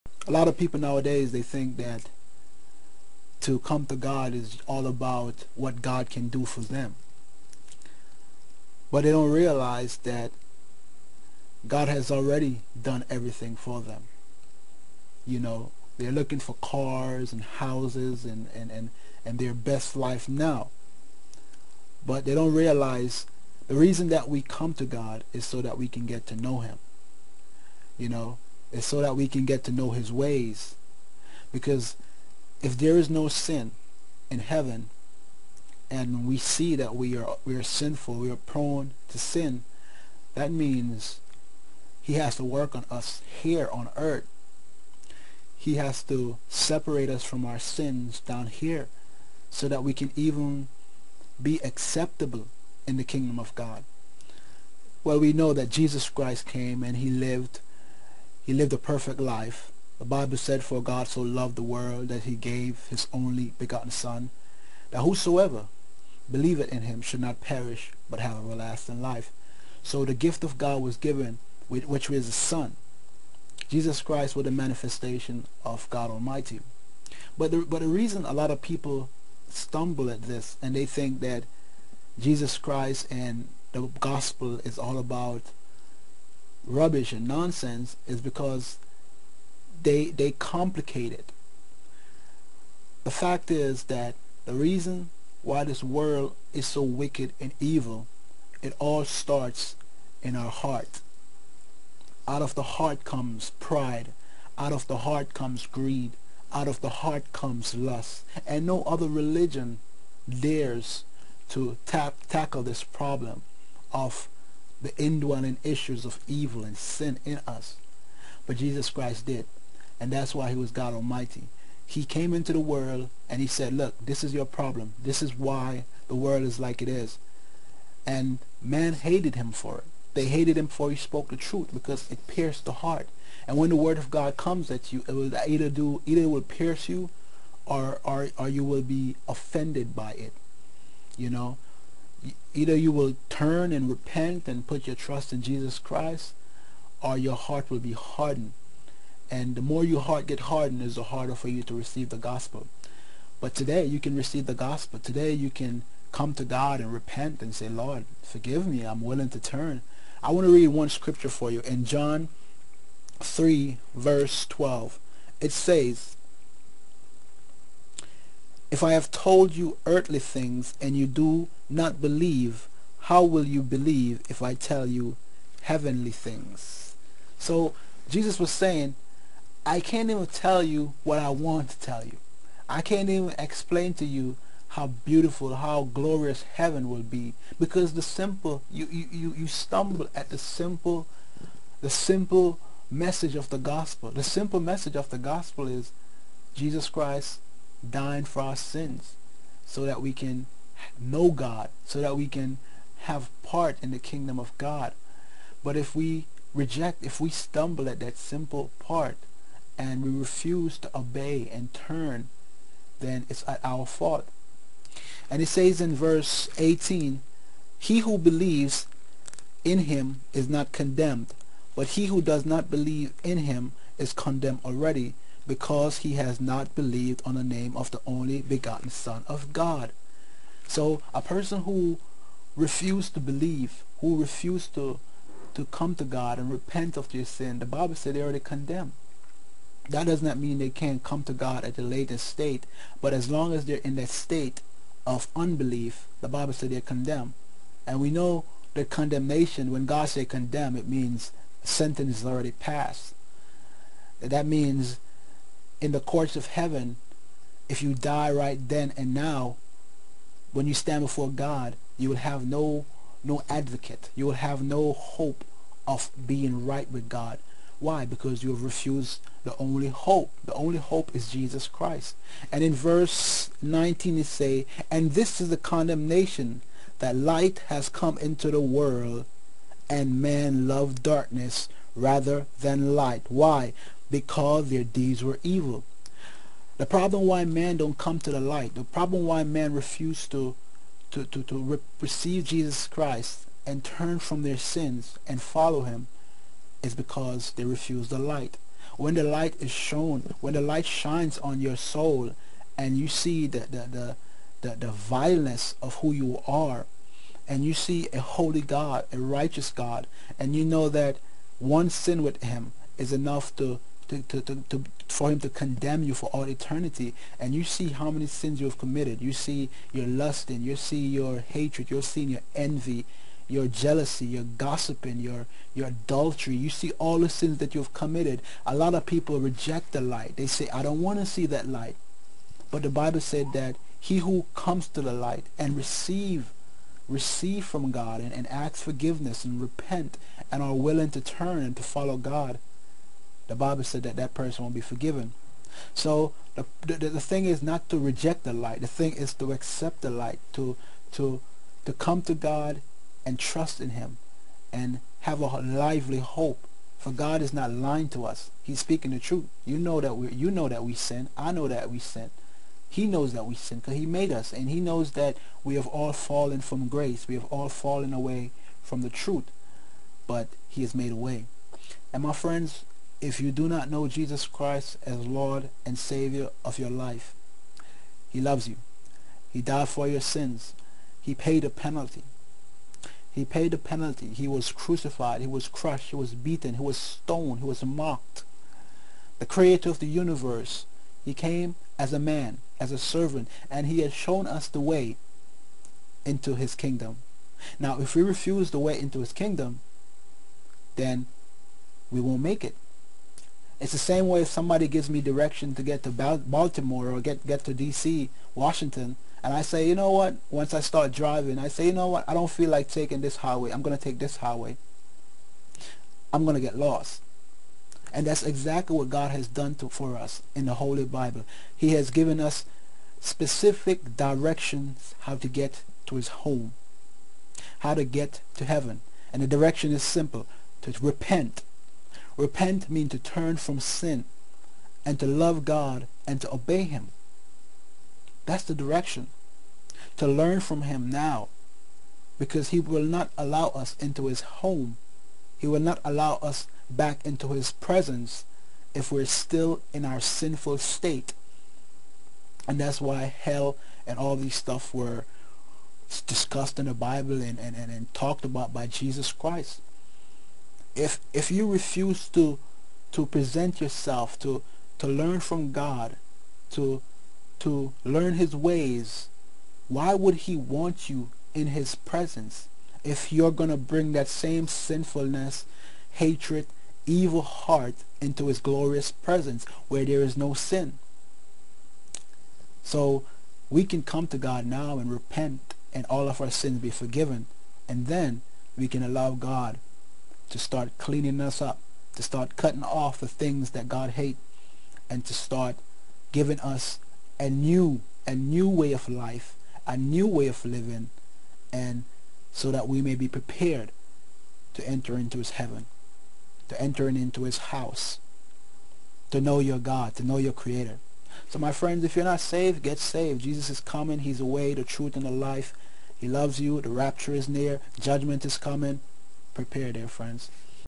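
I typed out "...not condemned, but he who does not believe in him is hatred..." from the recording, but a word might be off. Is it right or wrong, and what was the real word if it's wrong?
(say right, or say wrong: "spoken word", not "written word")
wrong: "condemned", not "hatred".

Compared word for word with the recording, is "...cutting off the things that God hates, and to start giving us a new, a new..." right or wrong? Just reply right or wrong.
right.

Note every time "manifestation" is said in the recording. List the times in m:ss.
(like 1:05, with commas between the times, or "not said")
1:14.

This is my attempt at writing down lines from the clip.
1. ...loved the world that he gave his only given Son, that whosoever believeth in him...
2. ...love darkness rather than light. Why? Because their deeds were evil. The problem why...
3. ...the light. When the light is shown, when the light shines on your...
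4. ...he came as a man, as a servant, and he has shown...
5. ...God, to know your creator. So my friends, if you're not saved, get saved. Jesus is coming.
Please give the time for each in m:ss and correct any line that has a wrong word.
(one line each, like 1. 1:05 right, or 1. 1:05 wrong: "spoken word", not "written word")
1. 1:01 wrong: "begotten", not "given"
2. 4:40 right
3. 4:58 right
4. 6:31 right
5. 8:29 right.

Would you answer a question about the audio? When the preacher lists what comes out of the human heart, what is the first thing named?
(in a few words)
Pride.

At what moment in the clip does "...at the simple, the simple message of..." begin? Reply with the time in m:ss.
3:10.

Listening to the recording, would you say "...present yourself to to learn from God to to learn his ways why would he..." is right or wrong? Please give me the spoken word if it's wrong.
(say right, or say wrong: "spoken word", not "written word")
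right.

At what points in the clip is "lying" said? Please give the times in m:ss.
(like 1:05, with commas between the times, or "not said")
5:57.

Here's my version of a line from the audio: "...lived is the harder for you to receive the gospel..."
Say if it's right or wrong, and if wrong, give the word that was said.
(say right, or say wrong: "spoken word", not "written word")
wrong: "hardened", not "lived".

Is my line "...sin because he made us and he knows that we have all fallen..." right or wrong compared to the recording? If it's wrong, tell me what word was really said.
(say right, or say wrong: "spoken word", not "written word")
right.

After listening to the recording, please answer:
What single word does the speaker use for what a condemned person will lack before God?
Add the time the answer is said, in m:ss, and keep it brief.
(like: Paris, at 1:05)
Advocate, at 4:23.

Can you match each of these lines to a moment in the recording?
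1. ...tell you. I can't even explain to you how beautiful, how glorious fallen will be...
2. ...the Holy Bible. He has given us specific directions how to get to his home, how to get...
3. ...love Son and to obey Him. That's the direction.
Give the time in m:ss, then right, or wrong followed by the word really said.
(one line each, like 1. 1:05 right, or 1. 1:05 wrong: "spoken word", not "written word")
1. 3:01 wrong: "heaven", not "fallen"
2. 7:00 right
3. 7:15 wrong: "God", not "Son".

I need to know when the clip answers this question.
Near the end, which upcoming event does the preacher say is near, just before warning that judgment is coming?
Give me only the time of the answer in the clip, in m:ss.
8:36.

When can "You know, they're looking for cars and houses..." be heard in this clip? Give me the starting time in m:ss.
0:15.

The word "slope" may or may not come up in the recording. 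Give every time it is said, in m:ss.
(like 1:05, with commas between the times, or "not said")
not said.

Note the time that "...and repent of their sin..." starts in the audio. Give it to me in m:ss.
3:56.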